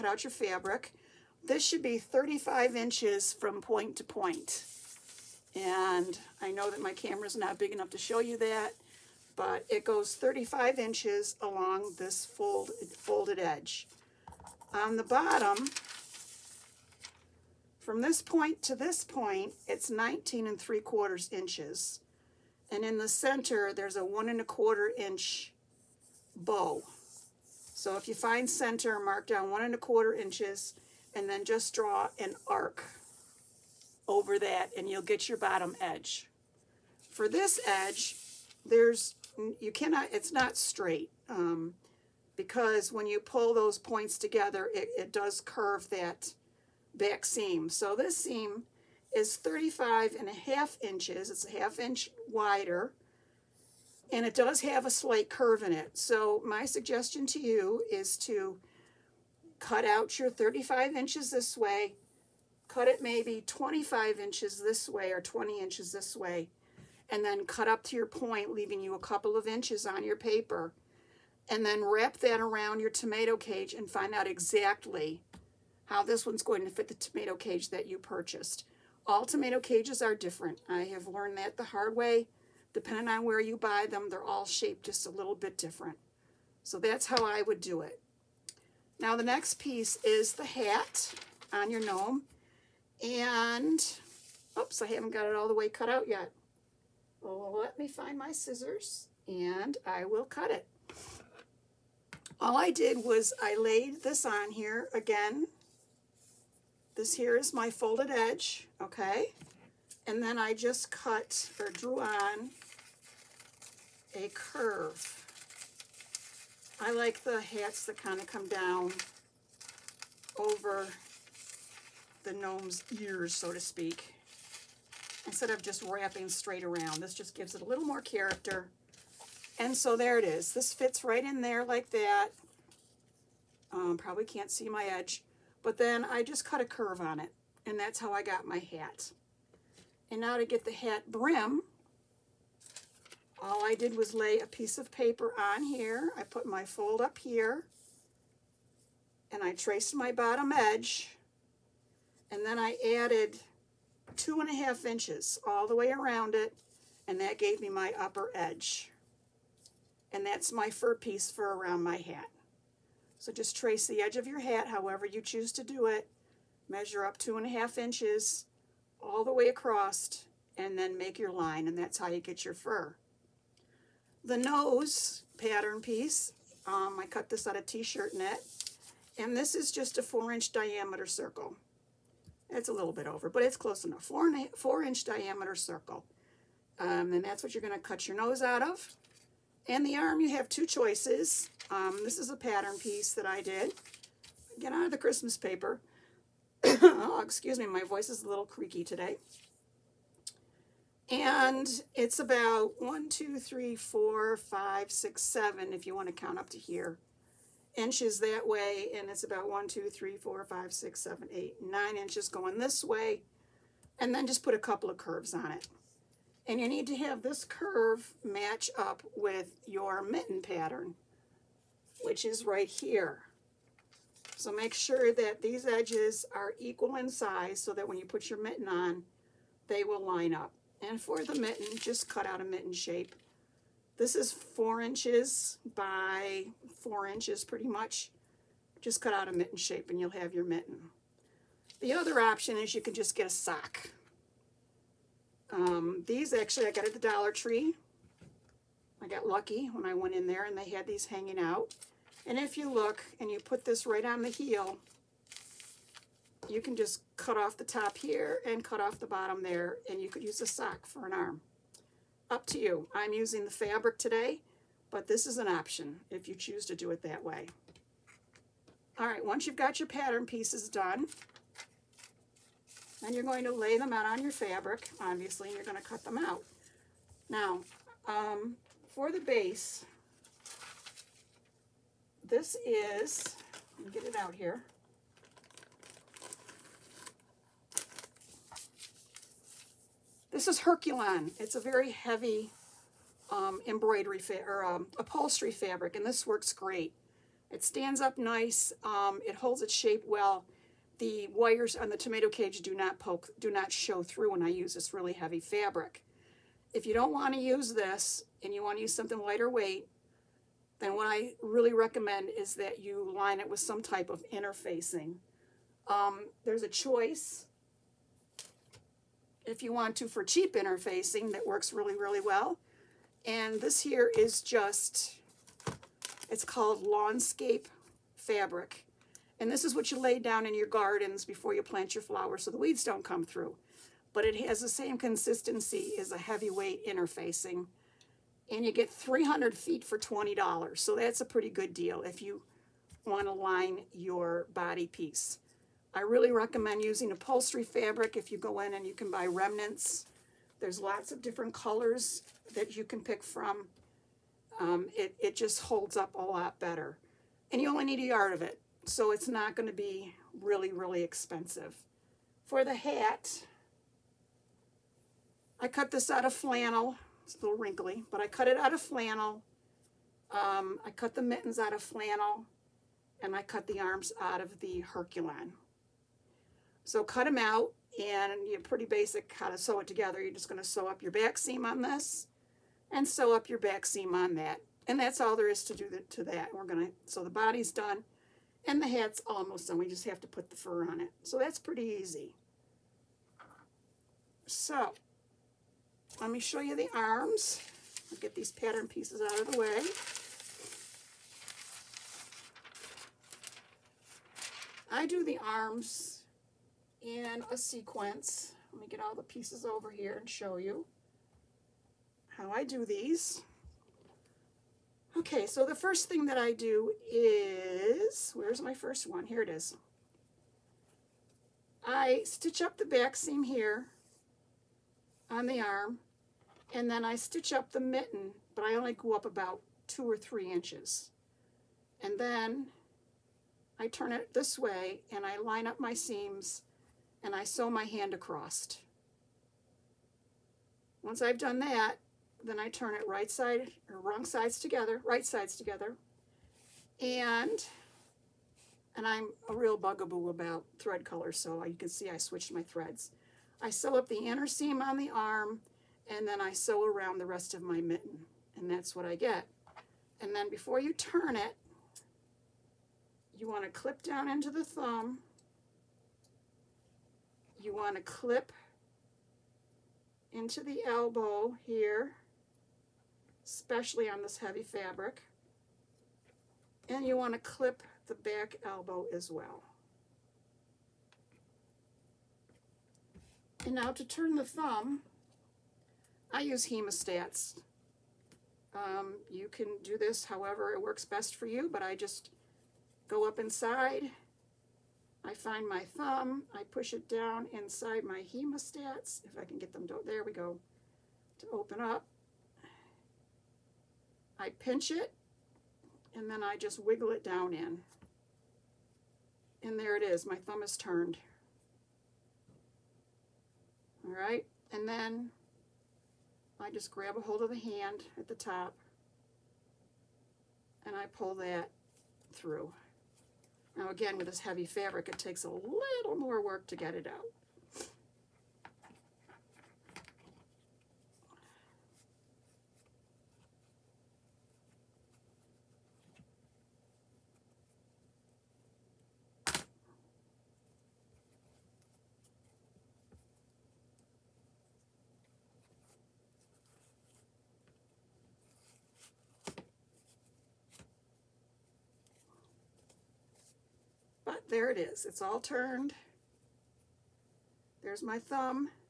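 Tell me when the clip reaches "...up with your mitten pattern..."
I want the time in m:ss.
3:38.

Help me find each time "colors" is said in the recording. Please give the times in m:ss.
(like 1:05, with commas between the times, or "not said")
5:51, 7:31.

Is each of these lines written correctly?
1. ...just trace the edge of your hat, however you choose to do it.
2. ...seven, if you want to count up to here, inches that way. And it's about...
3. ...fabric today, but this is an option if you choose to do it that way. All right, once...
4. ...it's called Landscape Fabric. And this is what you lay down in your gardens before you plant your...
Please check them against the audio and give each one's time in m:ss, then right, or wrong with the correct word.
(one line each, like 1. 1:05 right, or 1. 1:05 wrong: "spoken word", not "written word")
1. 2:43 right
2. 3:25 right
3. 4:23 right
4. 5:26 right.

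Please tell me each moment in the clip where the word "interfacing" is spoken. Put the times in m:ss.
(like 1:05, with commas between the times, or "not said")
5:14, 5:20, 5:36.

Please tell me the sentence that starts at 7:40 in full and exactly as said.
And then before you turn it, you want to clip down into the thumb.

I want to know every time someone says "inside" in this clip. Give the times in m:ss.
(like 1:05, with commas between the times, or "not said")
8:13, 8:17.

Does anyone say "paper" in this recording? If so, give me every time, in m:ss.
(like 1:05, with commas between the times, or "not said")
1:10, 2:24, 3:15.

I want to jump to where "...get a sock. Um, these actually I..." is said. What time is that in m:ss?
4:03.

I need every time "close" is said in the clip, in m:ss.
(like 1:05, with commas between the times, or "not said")
3:03.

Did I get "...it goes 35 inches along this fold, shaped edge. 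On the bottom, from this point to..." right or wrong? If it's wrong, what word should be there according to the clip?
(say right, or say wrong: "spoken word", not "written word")
wrong: "folded", not "shaped".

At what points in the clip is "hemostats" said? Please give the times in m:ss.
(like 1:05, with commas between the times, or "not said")
8:06, 8:18.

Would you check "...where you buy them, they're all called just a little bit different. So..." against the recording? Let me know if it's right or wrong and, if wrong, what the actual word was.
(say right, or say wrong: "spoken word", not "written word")
wrong: "shaped", not "called".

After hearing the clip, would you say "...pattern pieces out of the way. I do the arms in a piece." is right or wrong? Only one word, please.
wrong.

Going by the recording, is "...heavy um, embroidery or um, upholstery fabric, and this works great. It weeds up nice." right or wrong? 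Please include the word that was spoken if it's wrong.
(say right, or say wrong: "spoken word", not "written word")
wrong: "stands", not "weeds".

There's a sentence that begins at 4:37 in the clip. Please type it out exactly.
Now, um, for the base, this is, get it out here.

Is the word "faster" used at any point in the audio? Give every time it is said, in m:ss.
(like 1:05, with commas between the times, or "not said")
not said.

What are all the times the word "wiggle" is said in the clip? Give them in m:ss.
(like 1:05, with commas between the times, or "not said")
8:26.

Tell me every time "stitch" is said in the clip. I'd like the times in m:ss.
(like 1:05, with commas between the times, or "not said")
7:02, 7:07.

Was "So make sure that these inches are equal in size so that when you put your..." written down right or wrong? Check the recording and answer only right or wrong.
wrong.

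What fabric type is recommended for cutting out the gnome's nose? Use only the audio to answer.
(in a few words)
T-shirt knit.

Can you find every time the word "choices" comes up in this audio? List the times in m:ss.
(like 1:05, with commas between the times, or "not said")
3:10, 5:16.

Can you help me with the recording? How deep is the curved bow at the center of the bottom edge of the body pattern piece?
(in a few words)
1 1/4 inches.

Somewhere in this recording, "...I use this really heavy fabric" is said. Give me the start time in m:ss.
5:04.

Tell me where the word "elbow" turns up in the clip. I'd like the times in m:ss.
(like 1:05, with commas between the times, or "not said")
7:50, 7:58.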